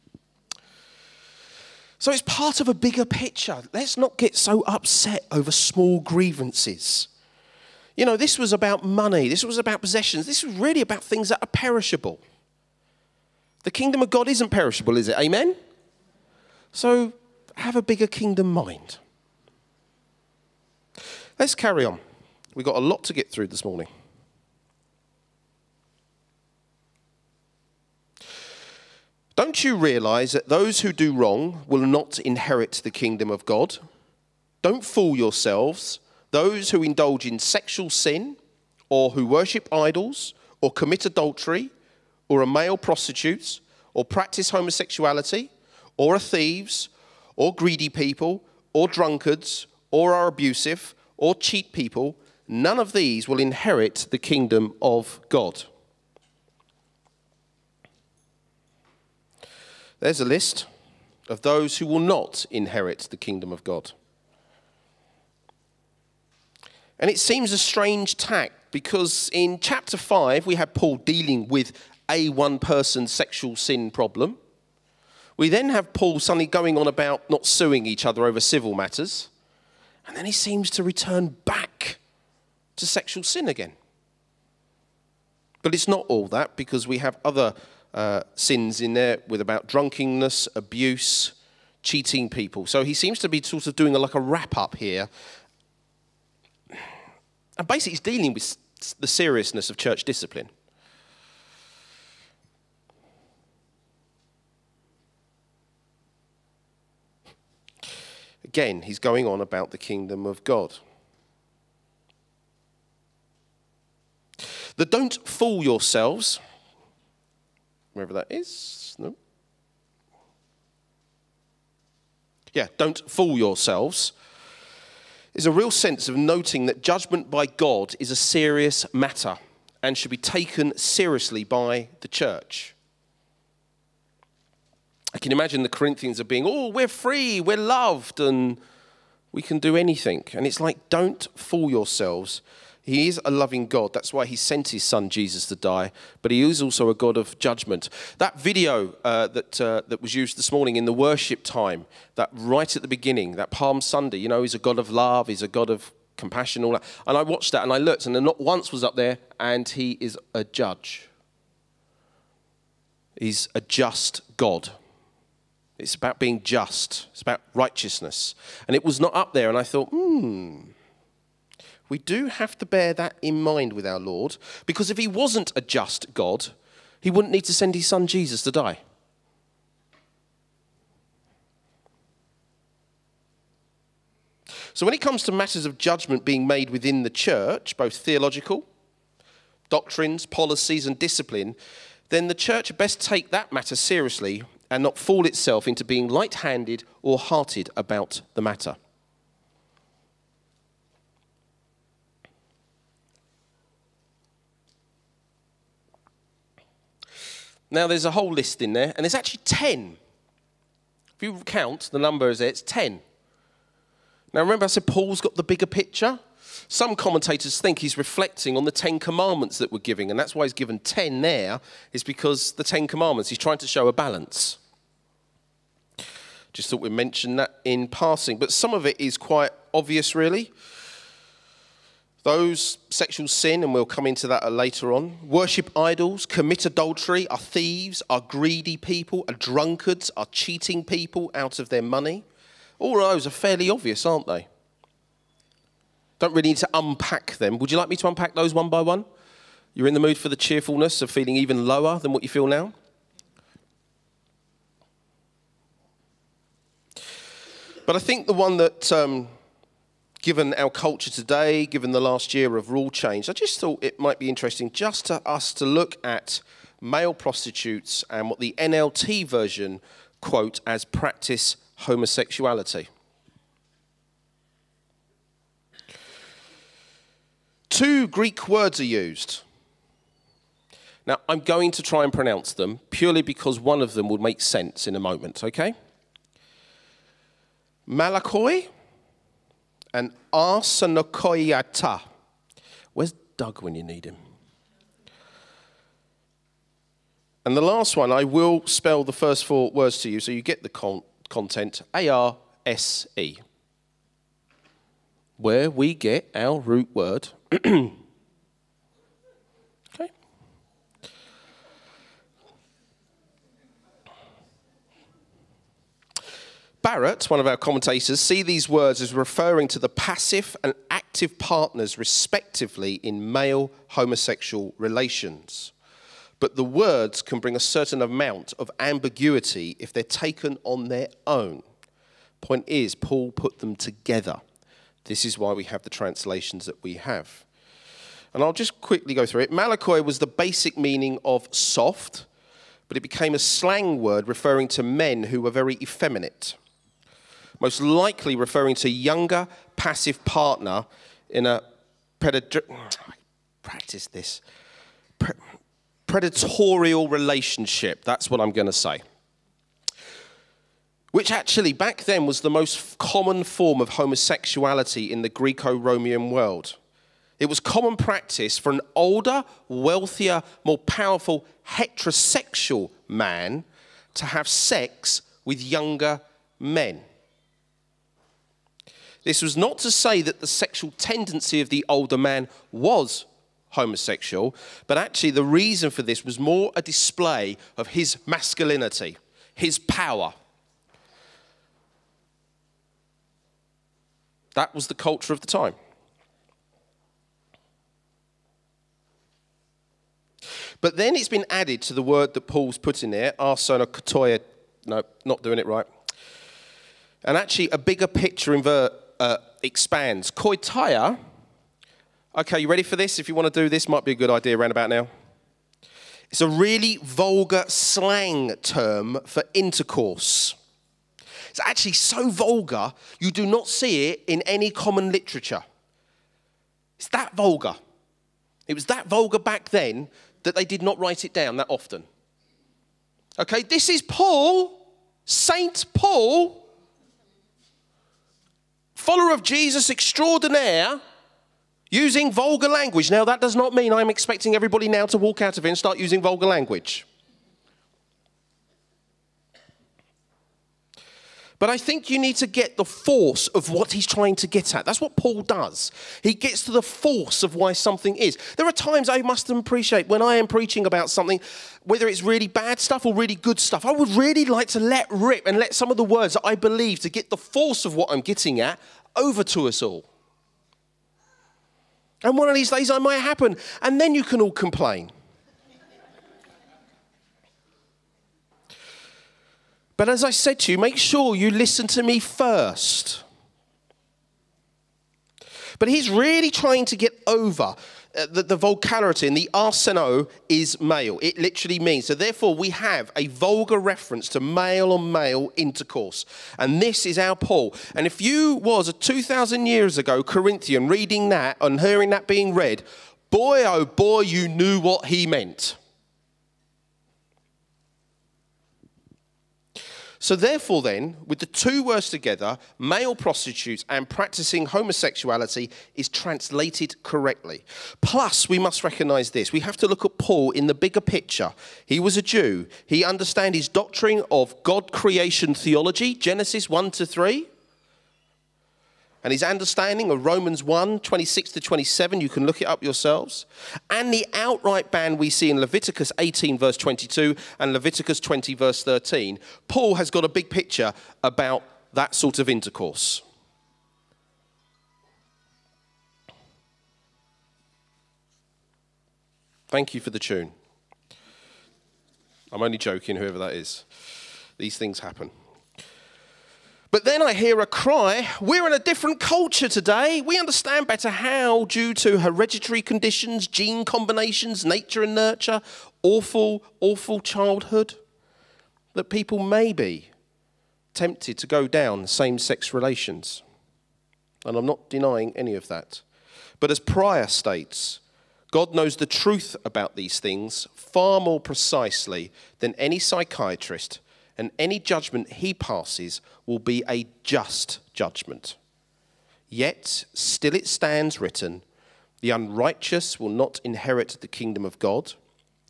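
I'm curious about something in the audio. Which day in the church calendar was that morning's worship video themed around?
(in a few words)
Palm Sunday.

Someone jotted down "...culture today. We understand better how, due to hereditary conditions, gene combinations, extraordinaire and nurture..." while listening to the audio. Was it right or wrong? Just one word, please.
wrong.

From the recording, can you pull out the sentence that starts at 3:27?
Now, there's a whole list in there, and there's actually 10.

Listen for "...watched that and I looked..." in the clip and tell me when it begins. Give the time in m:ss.
2:37.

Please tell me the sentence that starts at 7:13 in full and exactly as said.
Okay, this is Paul, Saint Paul, follower of Jesus extraordinaire, using vulgar language.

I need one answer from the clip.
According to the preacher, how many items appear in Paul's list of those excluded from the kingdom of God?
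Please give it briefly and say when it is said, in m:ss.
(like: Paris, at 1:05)
10, at 3:32.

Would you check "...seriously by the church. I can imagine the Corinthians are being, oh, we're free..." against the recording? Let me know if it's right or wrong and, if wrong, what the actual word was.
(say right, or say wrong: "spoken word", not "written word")
right.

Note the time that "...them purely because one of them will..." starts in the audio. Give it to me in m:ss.
4:42.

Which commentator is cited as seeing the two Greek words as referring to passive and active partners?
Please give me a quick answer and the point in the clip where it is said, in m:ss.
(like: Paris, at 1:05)
Barrett, at 5:16.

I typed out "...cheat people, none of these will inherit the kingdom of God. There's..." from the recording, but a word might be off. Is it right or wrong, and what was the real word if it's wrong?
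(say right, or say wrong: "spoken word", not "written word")
right.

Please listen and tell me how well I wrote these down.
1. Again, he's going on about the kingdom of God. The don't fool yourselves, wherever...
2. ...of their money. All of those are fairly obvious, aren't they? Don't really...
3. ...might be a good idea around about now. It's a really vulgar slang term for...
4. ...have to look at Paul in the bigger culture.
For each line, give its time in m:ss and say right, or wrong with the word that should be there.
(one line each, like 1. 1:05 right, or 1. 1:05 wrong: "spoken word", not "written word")
1. 1:48 right
2. 4:01 right
3. 6:53 right
4. 8:39 wrong: "picture", not "culture".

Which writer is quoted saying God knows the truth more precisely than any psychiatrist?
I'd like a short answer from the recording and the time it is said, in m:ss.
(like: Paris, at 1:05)
Prior, at 9:36.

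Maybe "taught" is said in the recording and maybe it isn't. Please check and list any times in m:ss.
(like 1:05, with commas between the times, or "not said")
not said.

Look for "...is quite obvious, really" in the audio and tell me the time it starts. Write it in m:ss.
3:49.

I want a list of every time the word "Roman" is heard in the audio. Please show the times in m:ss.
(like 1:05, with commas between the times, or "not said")
6:05, 8:50.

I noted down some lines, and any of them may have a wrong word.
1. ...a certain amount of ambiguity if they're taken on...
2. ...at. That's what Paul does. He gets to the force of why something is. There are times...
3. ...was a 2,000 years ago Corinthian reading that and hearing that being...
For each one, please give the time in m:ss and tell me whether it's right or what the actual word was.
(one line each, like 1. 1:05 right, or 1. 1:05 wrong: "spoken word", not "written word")
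1. 5:27 right
2. 7:34 right
3. 8:18 right.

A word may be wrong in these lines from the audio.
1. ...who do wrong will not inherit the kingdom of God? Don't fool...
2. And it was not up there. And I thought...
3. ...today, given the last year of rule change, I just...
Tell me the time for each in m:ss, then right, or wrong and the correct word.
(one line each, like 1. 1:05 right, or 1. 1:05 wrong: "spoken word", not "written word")
1. 0:30 right
2. 2:48 right
3. 4:21 right.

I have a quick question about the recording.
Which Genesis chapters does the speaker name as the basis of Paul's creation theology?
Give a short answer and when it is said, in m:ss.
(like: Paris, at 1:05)
Genesis 1 to 3, at 8:46.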